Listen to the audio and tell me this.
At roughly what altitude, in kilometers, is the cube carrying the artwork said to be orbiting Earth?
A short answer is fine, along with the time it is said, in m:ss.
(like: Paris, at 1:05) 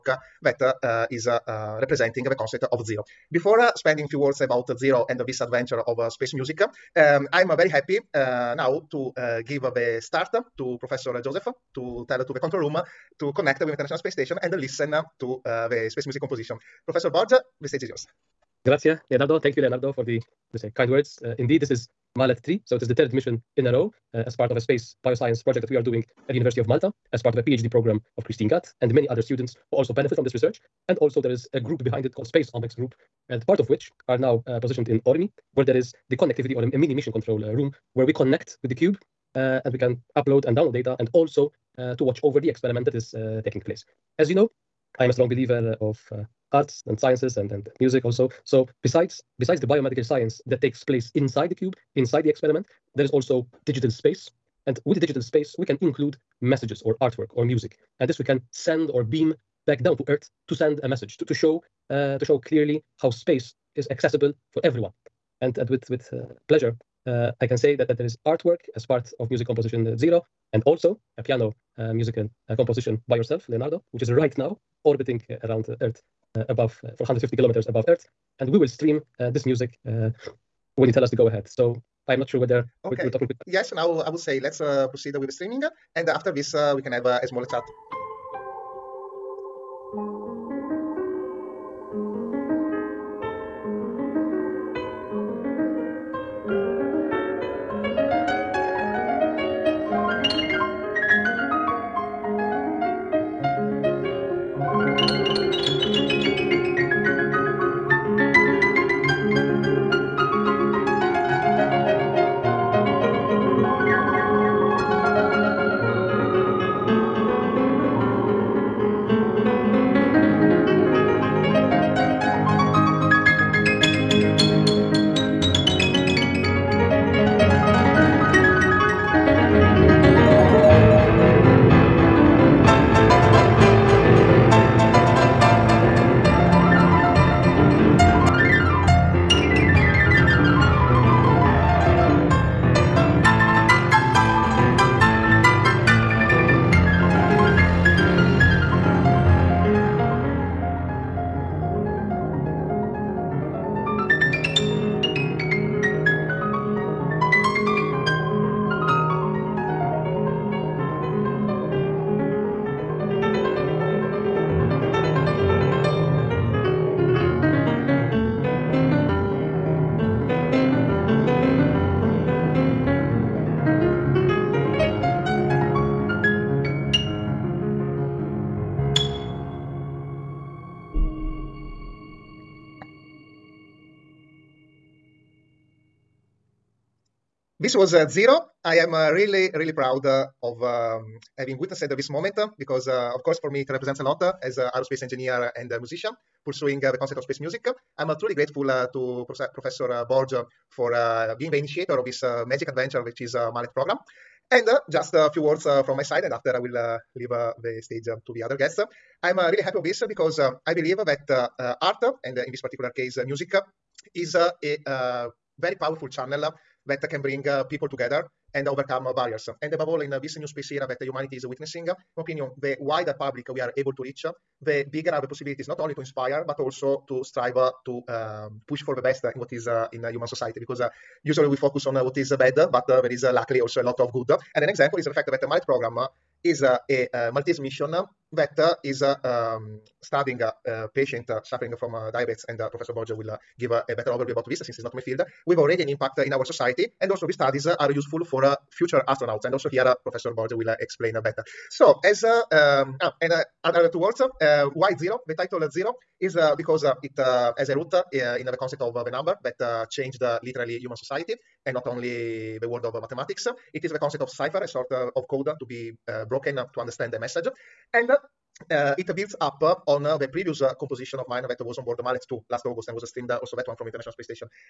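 450, at 1:16.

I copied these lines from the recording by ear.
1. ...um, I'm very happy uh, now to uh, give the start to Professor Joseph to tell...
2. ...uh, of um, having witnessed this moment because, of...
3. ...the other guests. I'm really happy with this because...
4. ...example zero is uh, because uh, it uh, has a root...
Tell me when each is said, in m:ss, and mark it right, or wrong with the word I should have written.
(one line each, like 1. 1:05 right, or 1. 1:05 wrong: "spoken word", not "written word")
1. 0:06 right
2. 3:10 right
3. 3:28 right
4. 4:15 wrong: "title", not "example".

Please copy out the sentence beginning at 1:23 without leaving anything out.
Yes, now I would say let's uh, proceed with the streaming.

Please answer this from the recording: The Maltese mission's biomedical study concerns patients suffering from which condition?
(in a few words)
Diabetes.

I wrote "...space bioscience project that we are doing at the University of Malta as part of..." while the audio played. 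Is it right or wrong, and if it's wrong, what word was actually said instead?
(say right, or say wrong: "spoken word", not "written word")
right.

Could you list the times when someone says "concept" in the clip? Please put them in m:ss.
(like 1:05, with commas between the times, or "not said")
0:02, 3:17, 4:18, 4:23.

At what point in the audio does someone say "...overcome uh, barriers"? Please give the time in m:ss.
3:38.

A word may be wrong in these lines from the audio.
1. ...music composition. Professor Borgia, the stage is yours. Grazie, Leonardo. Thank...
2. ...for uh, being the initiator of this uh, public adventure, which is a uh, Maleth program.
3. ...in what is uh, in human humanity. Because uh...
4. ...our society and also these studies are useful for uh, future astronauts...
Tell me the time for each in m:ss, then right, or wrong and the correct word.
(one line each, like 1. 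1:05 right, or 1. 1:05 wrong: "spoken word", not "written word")
1. 0:16 right
2. 3:20 wrong: "magic", not "public"
3. 3:49 wrong: "society", not "humanity"
4. 4:06 right.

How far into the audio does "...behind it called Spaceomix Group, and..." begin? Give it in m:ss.
0:31.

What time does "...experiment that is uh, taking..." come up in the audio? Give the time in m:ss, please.
0:42.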